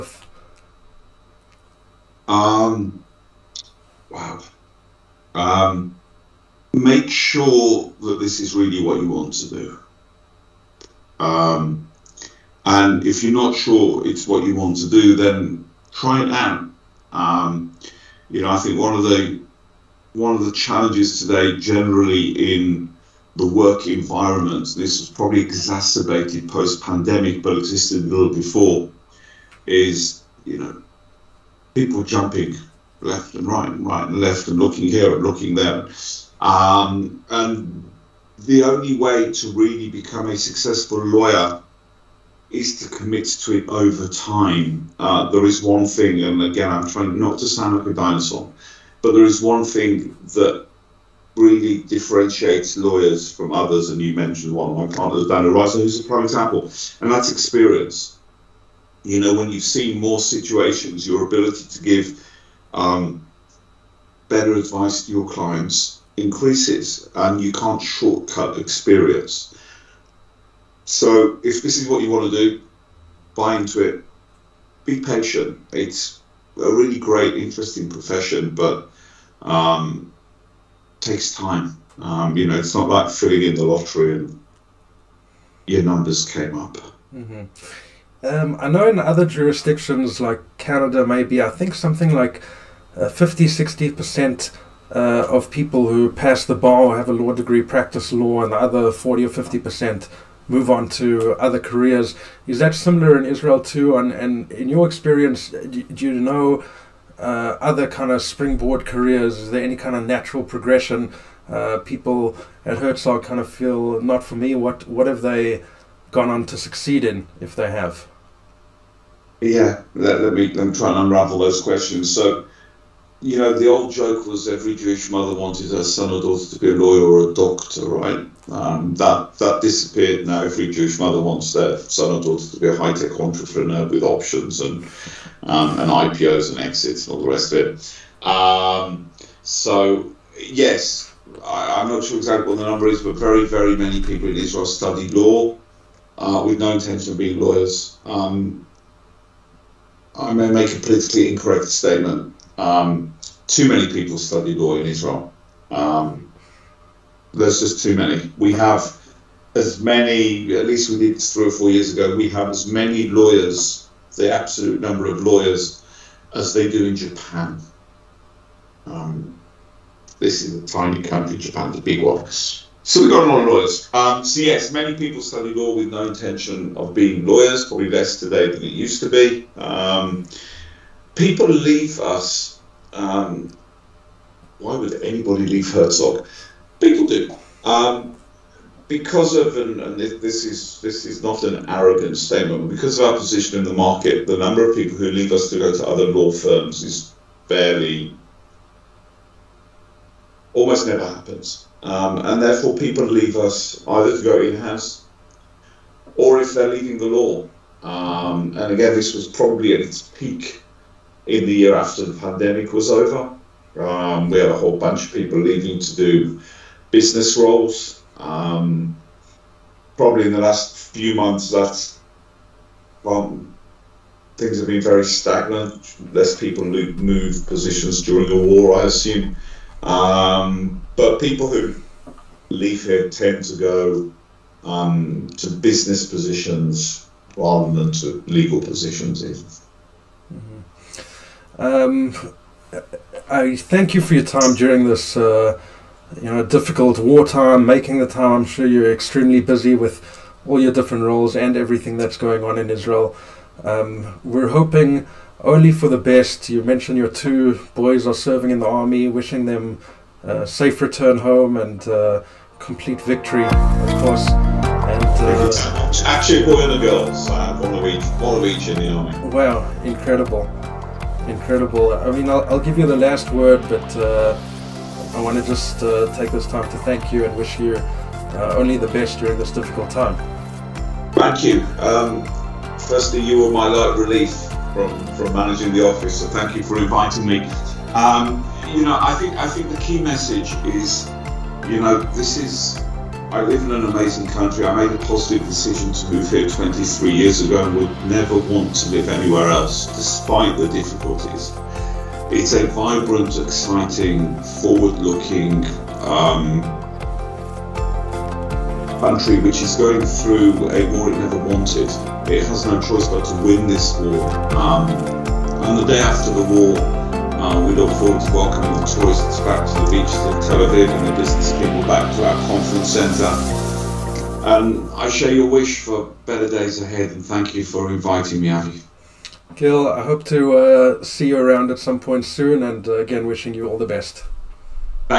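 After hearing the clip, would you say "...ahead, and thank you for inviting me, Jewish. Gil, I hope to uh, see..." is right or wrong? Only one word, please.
wrong.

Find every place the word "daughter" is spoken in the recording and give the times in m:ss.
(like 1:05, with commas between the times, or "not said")
2:06, 2:12.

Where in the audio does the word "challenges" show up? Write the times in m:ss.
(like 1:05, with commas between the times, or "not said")
0:20.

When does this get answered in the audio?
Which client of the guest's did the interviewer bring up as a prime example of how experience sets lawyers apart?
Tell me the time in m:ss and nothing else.
0:55.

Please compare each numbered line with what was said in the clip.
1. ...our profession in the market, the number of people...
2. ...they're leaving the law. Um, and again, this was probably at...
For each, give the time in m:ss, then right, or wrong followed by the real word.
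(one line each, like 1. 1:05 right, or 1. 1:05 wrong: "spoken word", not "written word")
1. 3:13 wrong: "position", not "profession"
2. 3:26 right.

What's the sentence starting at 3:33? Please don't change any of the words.
Um, we had a whole bunch of people leaving to do business roles.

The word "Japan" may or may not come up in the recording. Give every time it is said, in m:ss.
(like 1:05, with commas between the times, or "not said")
2:46, 2:51.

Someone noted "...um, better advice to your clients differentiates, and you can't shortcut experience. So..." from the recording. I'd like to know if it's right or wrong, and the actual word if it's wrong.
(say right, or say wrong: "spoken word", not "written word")
wrong: "increases", not "differentiates".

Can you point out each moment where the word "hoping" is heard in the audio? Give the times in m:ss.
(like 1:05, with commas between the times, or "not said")
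4:14.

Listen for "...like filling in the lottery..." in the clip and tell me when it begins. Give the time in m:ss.
1:22.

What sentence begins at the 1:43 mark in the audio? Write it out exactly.
And, and in your experience, uh, do, do you know uh, other kind of springboard careers?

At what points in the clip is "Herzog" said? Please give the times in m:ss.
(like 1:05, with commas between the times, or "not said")
1:52, 3:05.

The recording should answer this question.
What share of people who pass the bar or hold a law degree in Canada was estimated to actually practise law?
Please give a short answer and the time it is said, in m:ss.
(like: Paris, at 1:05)
50 60%, at 1:33.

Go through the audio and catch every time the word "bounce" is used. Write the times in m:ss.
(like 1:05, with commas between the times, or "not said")
not said.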